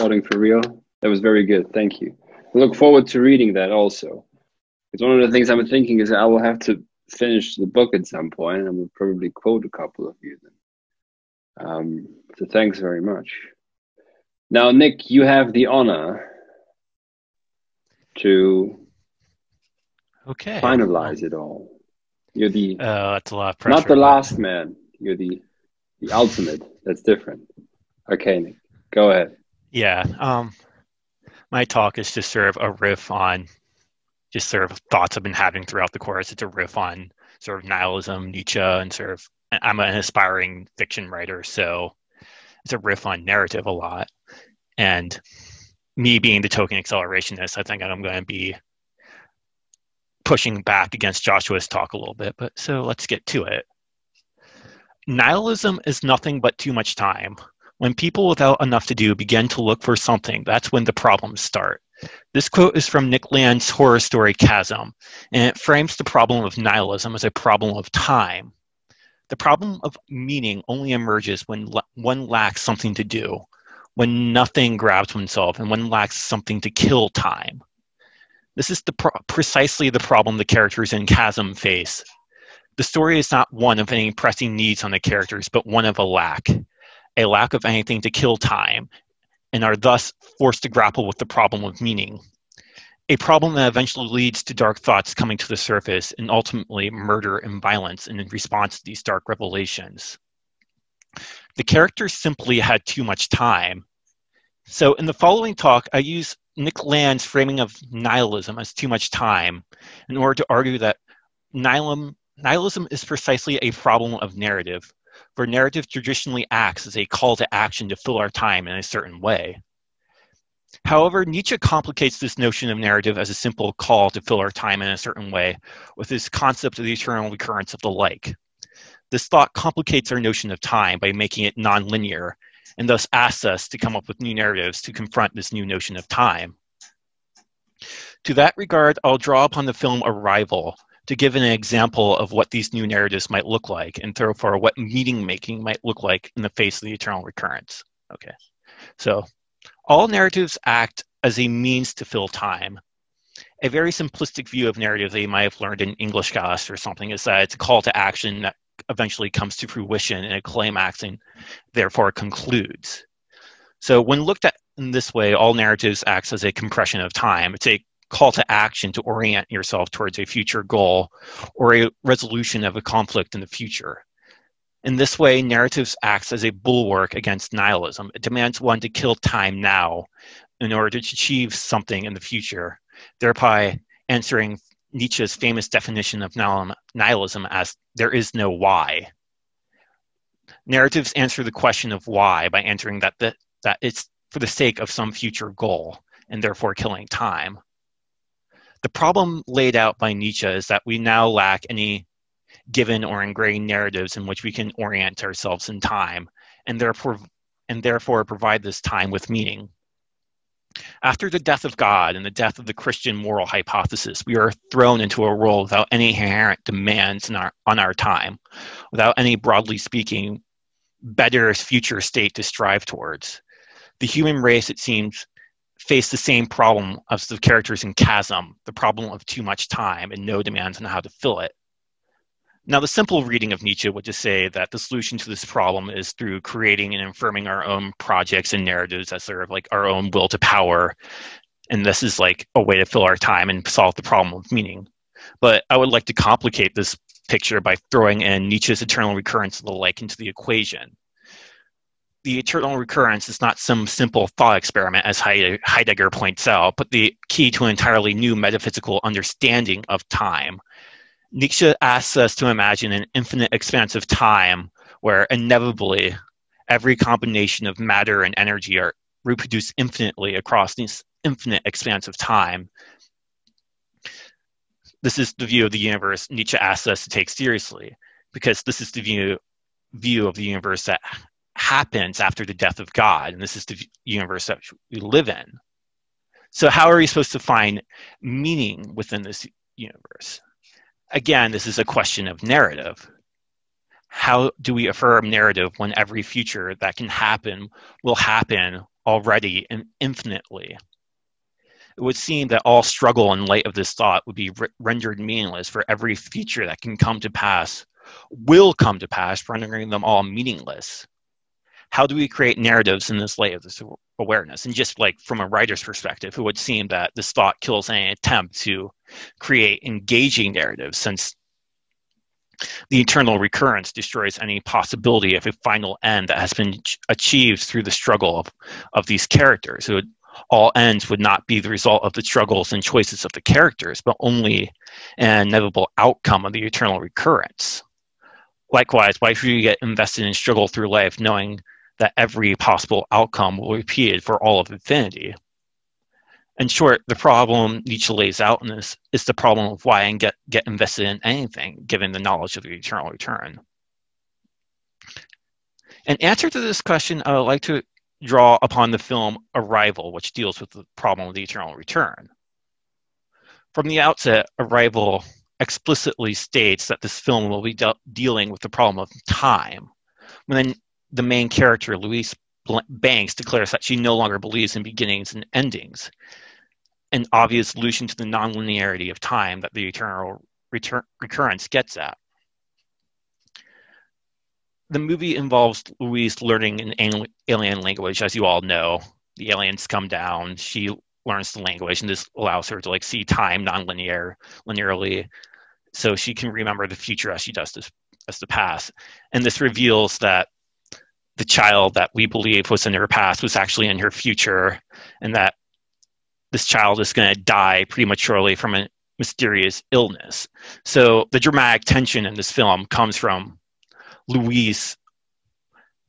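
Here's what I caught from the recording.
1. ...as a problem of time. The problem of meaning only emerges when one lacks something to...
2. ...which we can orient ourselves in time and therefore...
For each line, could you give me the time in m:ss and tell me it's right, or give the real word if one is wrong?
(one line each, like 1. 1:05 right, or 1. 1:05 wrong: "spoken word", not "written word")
1. 1:07 right
2. 3:24 right.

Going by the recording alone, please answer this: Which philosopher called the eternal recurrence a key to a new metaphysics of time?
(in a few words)
Heidegger.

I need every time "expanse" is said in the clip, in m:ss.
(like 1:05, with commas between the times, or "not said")
4:23, 4:31.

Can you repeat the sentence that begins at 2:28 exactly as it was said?
Okay, so all narratives act as a means to fill time.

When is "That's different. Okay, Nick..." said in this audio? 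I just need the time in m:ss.
0:26.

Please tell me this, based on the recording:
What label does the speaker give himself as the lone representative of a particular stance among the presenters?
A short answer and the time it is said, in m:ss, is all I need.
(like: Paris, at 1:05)
token accelerationist, at 0:46.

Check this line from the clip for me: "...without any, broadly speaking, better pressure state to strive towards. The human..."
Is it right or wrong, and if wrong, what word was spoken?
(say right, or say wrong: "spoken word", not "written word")
wrong: "future", not "pressure".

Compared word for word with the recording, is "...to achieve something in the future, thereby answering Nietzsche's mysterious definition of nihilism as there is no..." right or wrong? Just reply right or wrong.
wrong.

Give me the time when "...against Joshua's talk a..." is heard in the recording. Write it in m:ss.
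0:50.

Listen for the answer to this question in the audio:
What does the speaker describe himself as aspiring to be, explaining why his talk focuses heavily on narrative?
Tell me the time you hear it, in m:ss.
0:40.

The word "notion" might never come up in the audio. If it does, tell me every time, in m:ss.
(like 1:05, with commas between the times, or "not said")
2:02, 2:10, 2:15.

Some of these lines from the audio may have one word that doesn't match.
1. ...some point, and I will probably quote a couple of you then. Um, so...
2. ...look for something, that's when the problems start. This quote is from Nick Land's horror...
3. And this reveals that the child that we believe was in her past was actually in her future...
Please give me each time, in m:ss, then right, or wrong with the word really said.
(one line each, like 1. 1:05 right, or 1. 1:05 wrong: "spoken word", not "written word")
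1. 0:08 right
2. 0:59 right
3. 6:39 right.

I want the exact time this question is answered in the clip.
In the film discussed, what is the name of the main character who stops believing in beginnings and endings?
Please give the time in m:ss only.
6:11.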